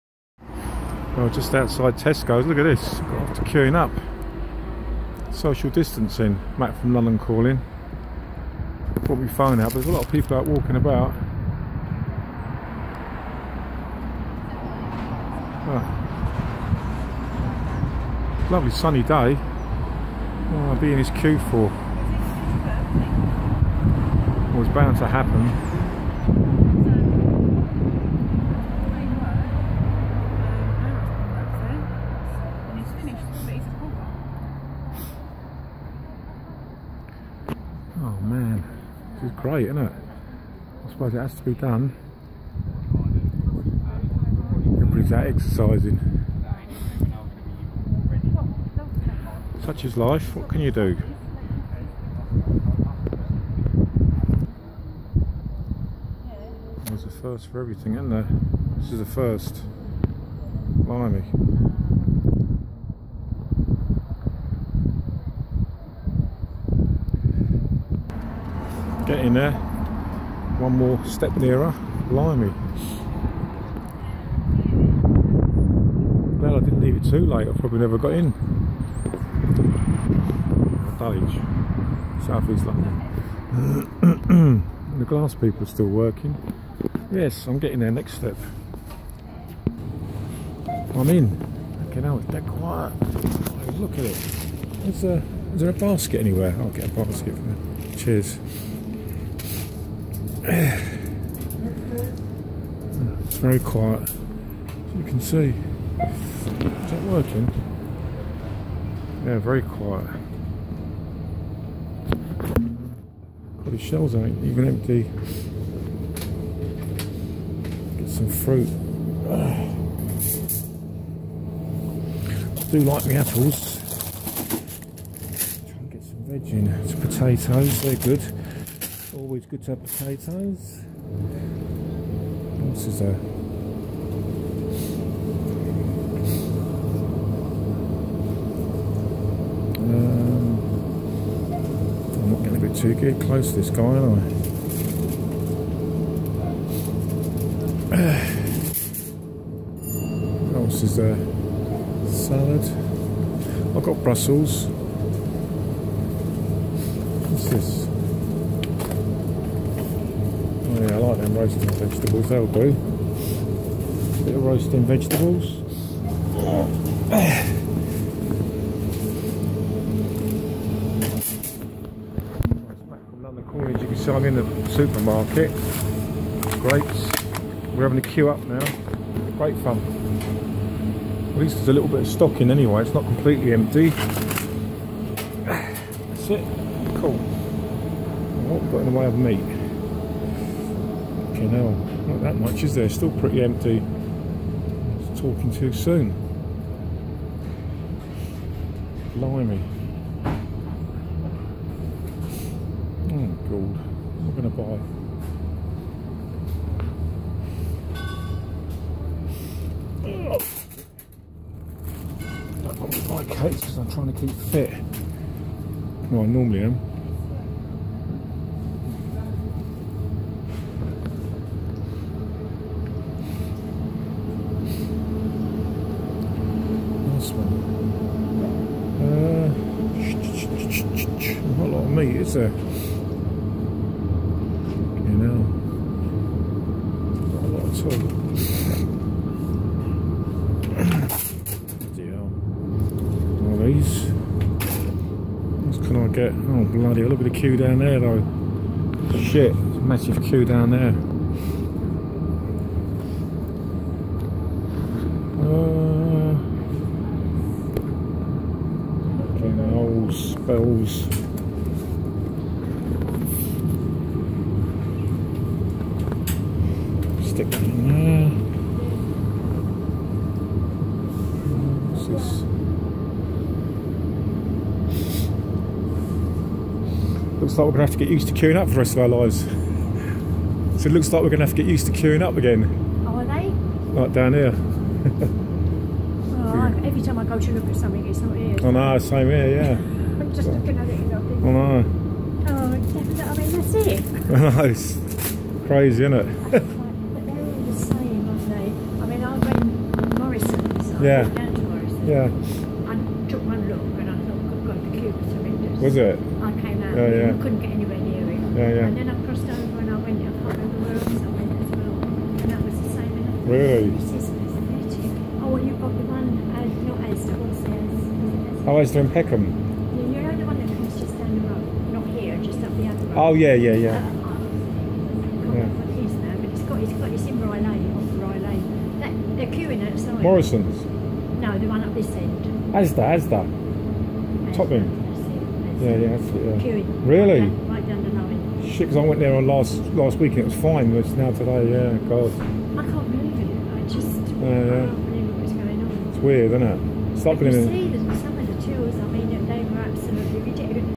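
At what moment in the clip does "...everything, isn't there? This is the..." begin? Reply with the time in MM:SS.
00:57.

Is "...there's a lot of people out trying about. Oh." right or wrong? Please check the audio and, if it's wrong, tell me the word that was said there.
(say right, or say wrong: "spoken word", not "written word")
wrong: "walking", not "trying".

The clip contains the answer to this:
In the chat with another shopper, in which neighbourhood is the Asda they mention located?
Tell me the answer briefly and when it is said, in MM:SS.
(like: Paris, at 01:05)
Peckham, at 05:19.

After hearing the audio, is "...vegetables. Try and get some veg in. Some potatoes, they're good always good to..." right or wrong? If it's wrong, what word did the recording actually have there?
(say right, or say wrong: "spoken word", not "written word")
wrong: "apples", not "vegetables".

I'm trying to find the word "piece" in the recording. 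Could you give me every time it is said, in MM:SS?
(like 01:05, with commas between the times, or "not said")
not said.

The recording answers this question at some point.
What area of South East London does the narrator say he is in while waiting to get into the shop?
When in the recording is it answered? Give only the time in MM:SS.
01:20.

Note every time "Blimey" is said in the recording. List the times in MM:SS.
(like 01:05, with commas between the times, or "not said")
01:00, 03:19.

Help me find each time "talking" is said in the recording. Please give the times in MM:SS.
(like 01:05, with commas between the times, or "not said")
03:15.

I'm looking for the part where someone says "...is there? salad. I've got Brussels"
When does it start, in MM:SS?
02:30.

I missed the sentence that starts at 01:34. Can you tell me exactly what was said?
Is there, uh, is there a basket anywhere?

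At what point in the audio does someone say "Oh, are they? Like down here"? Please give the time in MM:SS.
04:43.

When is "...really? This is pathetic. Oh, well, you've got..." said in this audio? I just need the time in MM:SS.
05:13.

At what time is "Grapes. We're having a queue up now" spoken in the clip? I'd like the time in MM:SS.
02:56.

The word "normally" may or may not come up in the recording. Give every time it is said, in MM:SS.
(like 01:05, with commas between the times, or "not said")
03:36.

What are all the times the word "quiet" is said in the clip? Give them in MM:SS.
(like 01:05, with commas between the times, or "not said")
01:32, 01:43, 01:49.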